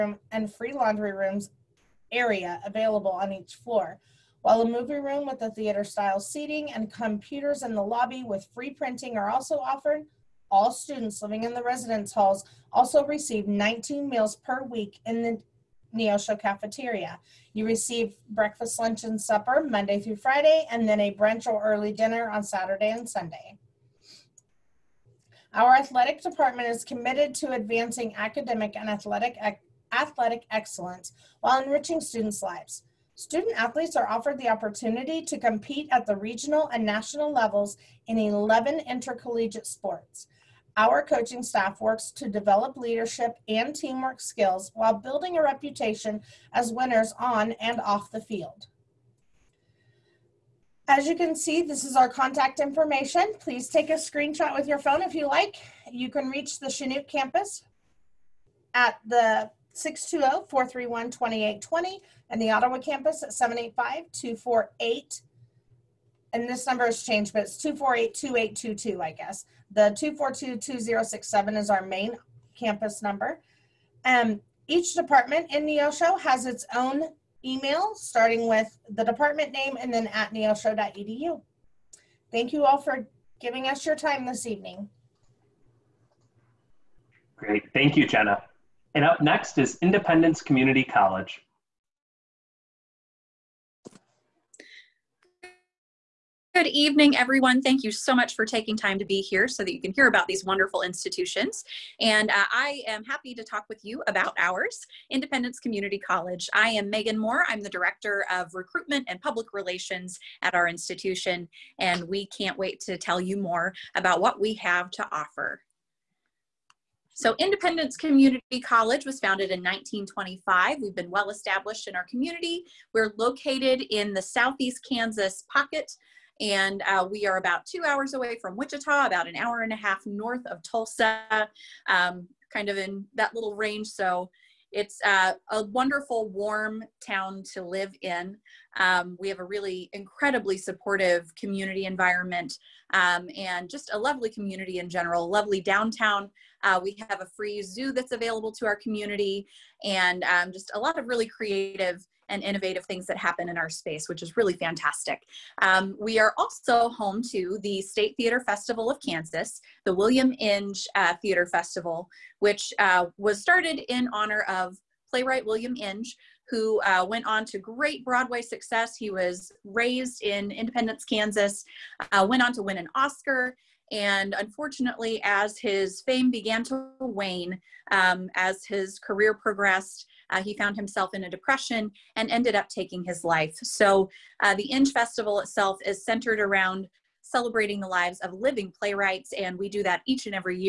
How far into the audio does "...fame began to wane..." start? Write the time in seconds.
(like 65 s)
176 s.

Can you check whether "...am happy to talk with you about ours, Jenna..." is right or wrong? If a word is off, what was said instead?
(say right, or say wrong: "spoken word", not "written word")
wrong: "Independence", not "Jenna".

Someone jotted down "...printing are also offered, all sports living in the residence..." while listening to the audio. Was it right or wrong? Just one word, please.
wrong.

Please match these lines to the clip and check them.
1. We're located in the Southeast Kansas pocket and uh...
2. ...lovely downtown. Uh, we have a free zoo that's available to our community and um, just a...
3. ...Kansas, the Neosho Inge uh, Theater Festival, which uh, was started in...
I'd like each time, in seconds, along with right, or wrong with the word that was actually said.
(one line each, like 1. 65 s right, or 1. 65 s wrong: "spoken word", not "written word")
1. 122 s right
2. 145 s right
3. 159 s wrong: "William", not "Neosho".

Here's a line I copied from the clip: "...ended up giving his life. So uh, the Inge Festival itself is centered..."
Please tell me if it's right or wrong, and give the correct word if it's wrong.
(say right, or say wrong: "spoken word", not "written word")
wrong: "taking", not "giving".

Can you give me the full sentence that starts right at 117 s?
So Independence Community College was founded in 1925.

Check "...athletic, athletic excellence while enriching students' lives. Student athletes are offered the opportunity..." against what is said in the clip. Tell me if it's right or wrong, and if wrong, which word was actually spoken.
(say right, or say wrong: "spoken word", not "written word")
right.